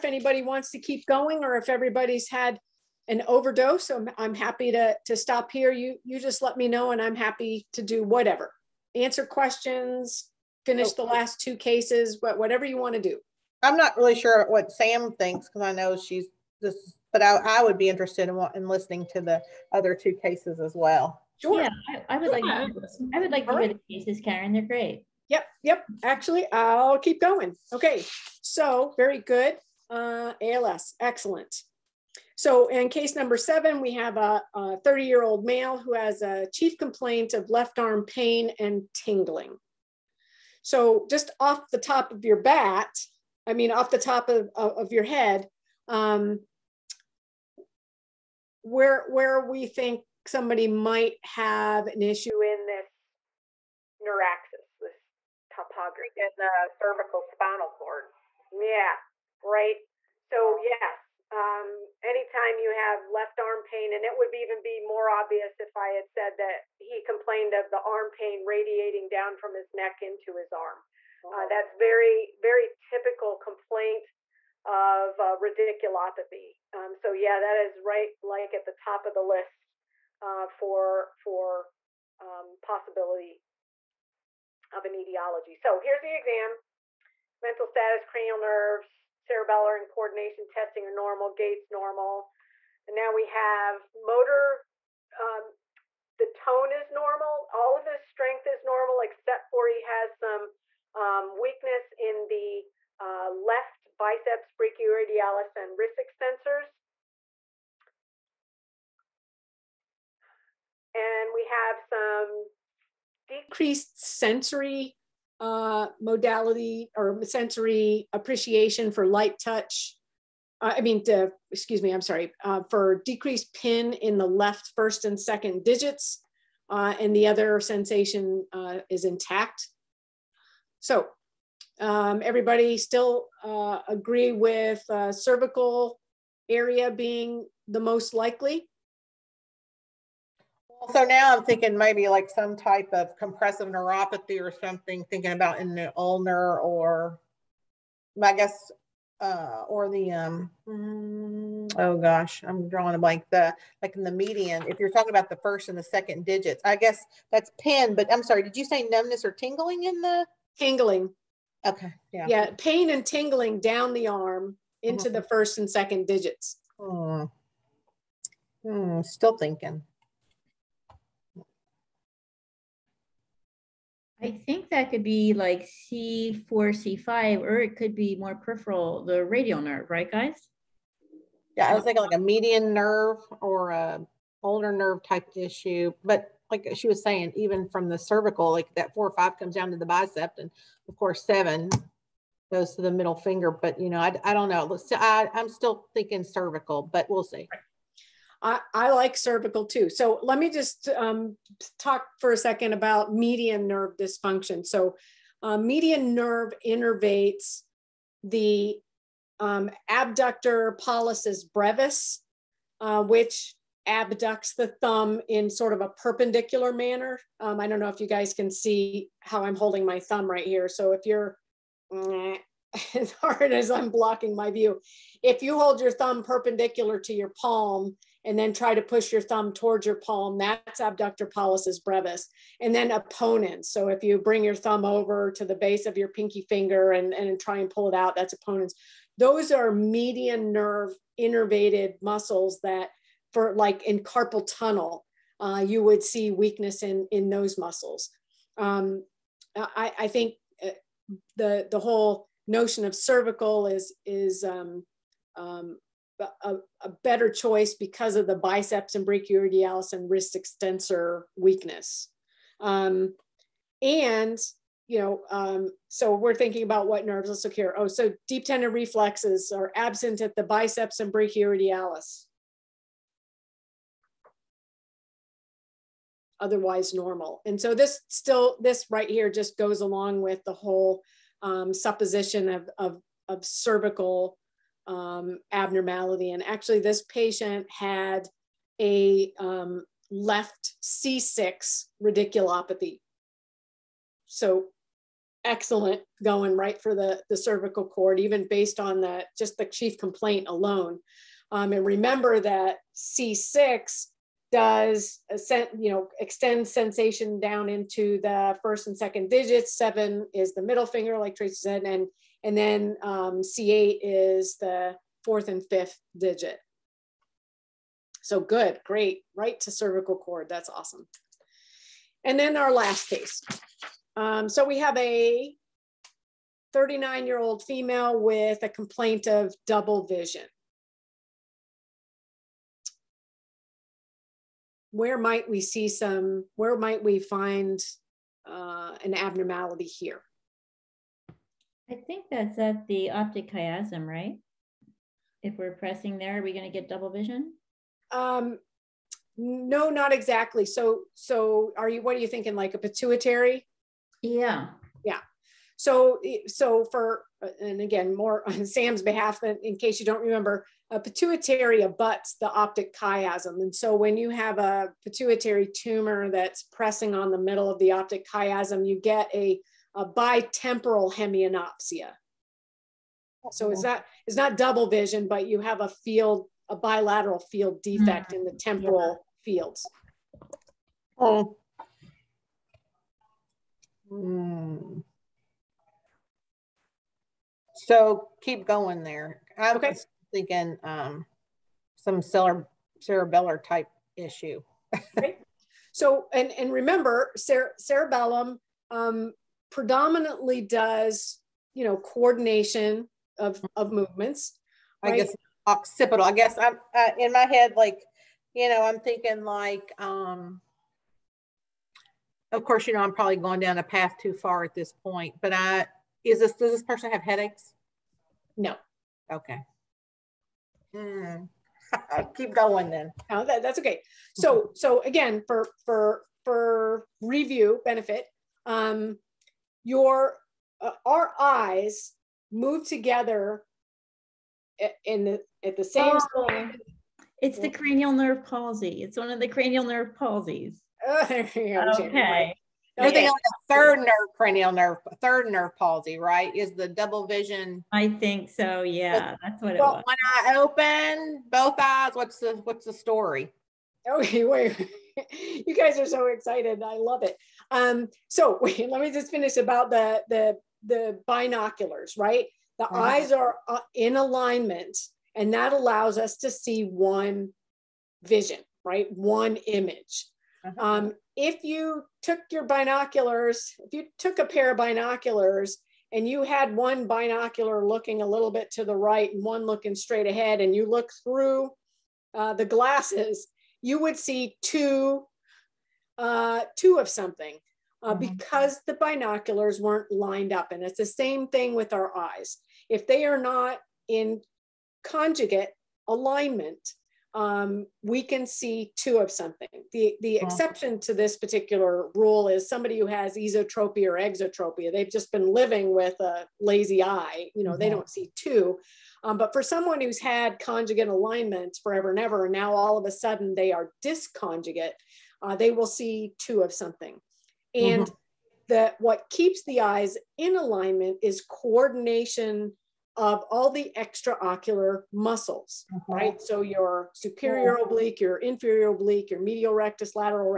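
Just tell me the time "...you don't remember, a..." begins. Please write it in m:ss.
6:00.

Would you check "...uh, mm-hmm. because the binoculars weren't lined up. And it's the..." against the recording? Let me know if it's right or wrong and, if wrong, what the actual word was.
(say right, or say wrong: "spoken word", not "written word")
right.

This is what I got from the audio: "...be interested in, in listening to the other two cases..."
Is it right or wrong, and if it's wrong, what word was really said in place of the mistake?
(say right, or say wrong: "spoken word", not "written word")
right.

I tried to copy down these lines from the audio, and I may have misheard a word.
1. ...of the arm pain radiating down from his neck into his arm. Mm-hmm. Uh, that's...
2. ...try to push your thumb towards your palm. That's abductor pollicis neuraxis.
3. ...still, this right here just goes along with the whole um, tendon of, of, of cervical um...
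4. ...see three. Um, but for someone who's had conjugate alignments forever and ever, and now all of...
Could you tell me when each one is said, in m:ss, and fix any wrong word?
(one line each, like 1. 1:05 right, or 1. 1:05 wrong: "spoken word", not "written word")
1. 1:07 right
2. 3:48 wrong: "brevis", not "neuraxis"
3. 4:38 wrong: "supposition", not "tendon"
4. 8:28 wrong: "two", not "three".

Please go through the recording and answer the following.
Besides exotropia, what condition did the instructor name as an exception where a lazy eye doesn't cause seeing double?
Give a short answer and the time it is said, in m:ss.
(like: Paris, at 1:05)
Esotropia, at 8:23.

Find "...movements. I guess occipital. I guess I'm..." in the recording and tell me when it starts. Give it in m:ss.
6:43.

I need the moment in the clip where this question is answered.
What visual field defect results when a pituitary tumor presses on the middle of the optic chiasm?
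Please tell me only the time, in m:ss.
6:10.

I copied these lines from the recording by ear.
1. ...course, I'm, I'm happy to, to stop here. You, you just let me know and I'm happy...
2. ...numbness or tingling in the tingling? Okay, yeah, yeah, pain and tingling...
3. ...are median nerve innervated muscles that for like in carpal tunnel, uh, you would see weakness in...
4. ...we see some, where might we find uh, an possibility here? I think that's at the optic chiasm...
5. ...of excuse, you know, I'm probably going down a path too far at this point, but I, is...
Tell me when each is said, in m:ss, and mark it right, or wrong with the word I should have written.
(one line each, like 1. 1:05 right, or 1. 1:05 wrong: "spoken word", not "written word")
1. 0:03 wrong: "overdose", not "course"
2. 2:38 right
3. 3:59 right
4. 5:35 wrong: "abnormality", not "possibility"
5. 6:52 wrong: "course", not "excuse".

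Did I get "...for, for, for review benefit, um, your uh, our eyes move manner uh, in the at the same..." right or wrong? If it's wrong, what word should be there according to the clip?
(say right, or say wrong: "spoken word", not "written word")
wrong: "together", not "manner".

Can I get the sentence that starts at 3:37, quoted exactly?
Um, I don't know if you guys can see how I'm holding my thumb right here.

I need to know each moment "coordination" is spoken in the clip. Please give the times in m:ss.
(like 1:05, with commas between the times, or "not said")
1:29, 6:41, 8:41.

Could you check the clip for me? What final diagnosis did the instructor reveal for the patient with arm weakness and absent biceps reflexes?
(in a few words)
Left C6 radiculopathy.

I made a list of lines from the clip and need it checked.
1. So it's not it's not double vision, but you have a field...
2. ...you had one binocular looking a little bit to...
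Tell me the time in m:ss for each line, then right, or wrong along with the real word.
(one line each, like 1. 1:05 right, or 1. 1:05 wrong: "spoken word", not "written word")
1. 6:13 right
2. 7:56 right.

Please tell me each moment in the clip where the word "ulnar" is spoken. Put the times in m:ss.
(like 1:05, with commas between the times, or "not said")
2:25, 3:04.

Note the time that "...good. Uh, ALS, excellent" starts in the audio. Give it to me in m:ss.
0:29.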